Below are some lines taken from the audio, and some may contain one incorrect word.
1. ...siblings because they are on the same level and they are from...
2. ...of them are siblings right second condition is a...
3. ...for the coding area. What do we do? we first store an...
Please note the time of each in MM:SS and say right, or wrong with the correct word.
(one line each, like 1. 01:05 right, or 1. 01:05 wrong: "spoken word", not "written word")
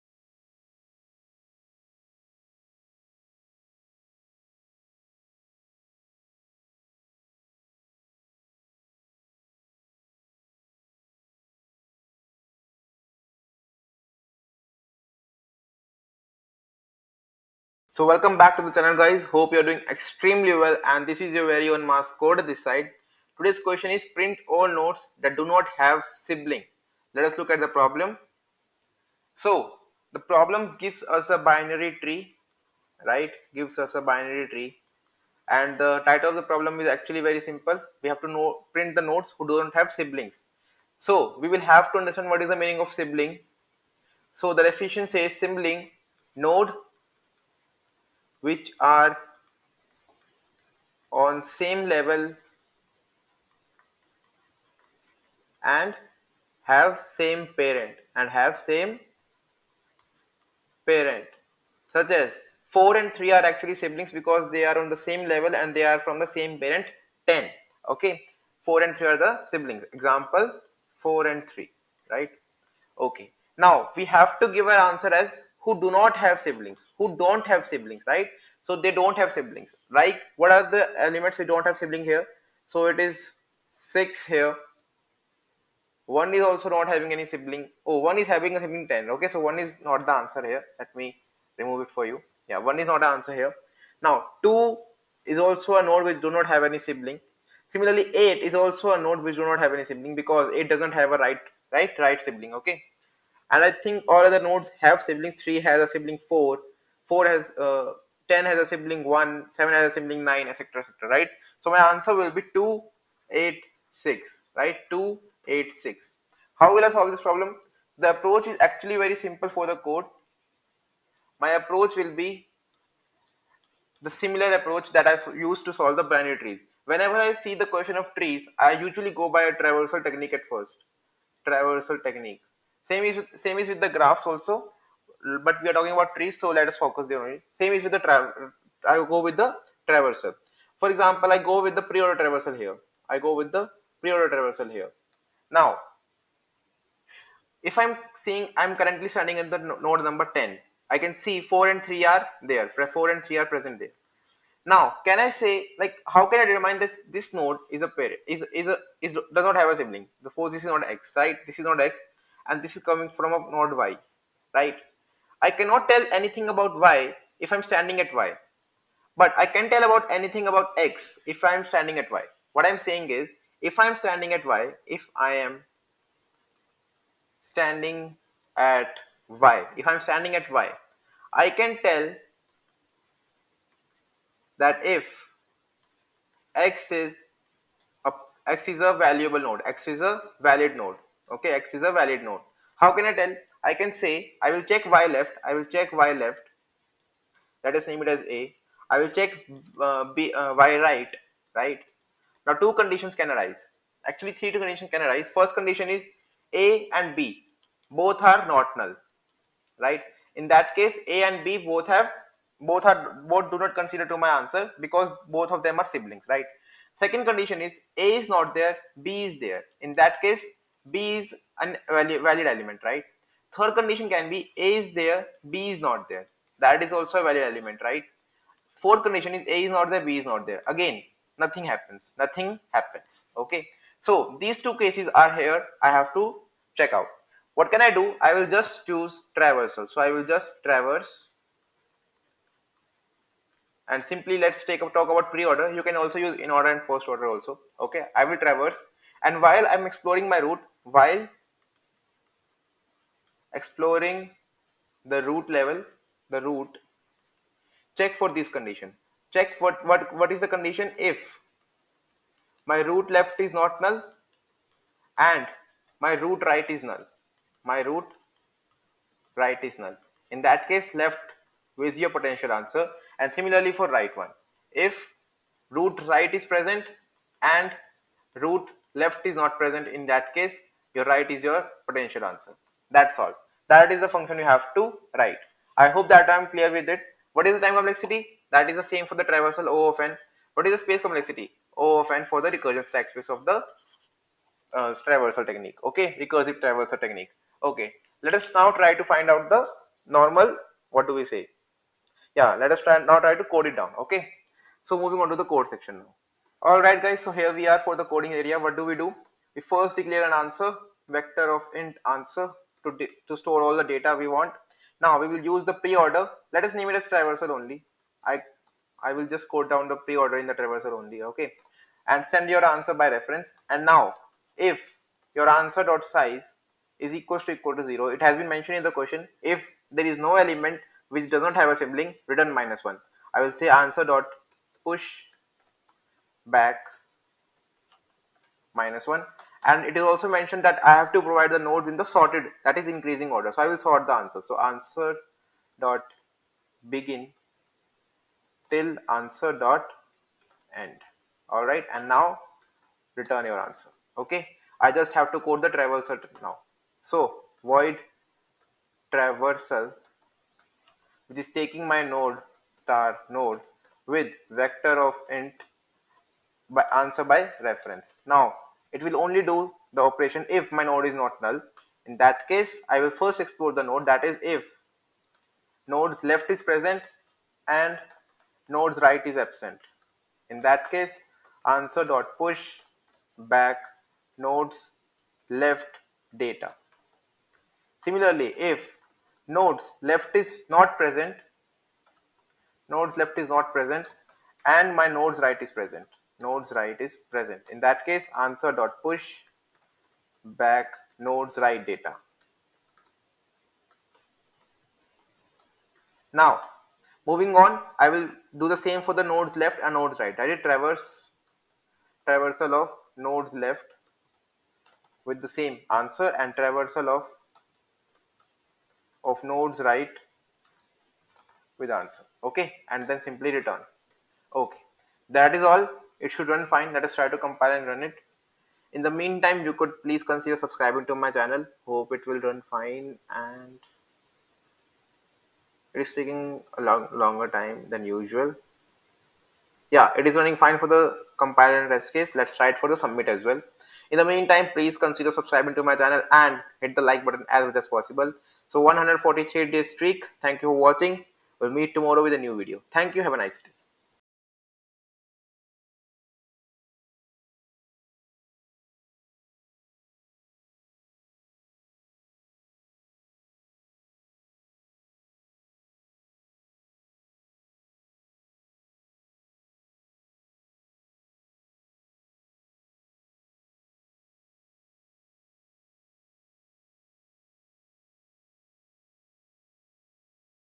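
1. 01:03 right
2. 03:35 right
3. 05:07 wrong: "declare", not "store".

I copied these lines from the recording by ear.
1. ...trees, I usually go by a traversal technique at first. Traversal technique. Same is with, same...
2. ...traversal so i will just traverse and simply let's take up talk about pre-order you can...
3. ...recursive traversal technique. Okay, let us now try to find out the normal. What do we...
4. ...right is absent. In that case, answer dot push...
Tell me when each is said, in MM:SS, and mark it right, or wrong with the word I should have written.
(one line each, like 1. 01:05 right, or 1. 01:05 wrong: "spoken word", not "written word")
1. 02:08 right
2. 03:59 right
3. 04:56 right
4. 06:19 right.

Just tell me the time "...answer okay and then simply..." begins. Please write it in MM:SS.
07:01.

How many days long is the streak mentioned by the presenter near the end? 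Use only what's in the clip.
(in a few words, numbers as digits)
143.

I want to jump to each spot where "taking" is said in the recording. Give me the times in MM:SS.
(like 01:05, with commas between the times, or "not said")
06:01, 07:16.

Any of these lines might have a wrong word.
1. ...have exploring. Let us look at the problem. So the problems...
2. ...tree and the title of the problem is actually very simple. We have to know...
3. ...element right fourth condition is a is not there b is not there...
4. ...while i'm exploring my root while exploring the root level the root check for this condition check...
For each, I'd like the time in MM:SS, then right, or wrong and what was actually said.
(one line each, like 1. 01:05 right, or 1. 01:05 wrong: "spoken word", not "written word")
1. 00:25 wrong: "sibling", not "exploring"
2. 00:34 right
3. 03:47 right
4. 04:09 right.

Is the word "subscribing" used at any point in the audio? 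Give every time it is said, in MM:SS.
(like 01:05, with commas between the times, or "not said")
07:10, 07:25.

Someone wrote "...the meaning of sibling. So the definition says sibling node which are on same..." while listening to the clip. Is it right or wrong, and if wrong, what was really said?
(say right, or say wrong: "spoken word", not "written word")
right.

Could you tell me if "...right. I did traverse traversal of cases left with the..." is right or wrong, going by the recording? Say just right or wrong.
wrong.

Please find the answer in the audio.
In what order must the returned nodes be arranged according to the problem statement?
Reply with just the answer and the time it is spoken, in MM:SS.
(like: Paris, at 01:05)
increasing order, at 05:42.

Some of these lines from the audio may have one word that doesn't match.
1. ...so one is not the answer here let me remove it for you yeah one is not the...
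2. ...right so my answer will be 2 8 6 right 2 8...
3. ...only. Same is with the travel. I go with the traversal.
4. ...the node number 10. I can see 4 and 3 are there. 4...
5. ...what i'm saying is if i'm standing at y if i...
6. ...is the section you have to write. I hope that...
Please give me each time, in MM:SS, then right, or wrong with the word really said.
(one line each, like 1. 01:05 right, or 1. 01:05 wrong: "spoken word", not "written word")
1. 01:29 right
2. 01:51 right
3. 02:17 right
4. 02:29 right
5. 02:52 right
6. 04:43 wrong: "function", not "section".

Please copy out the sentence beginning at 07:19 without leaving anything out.
Yeah, it is running fine for the compile and rest case.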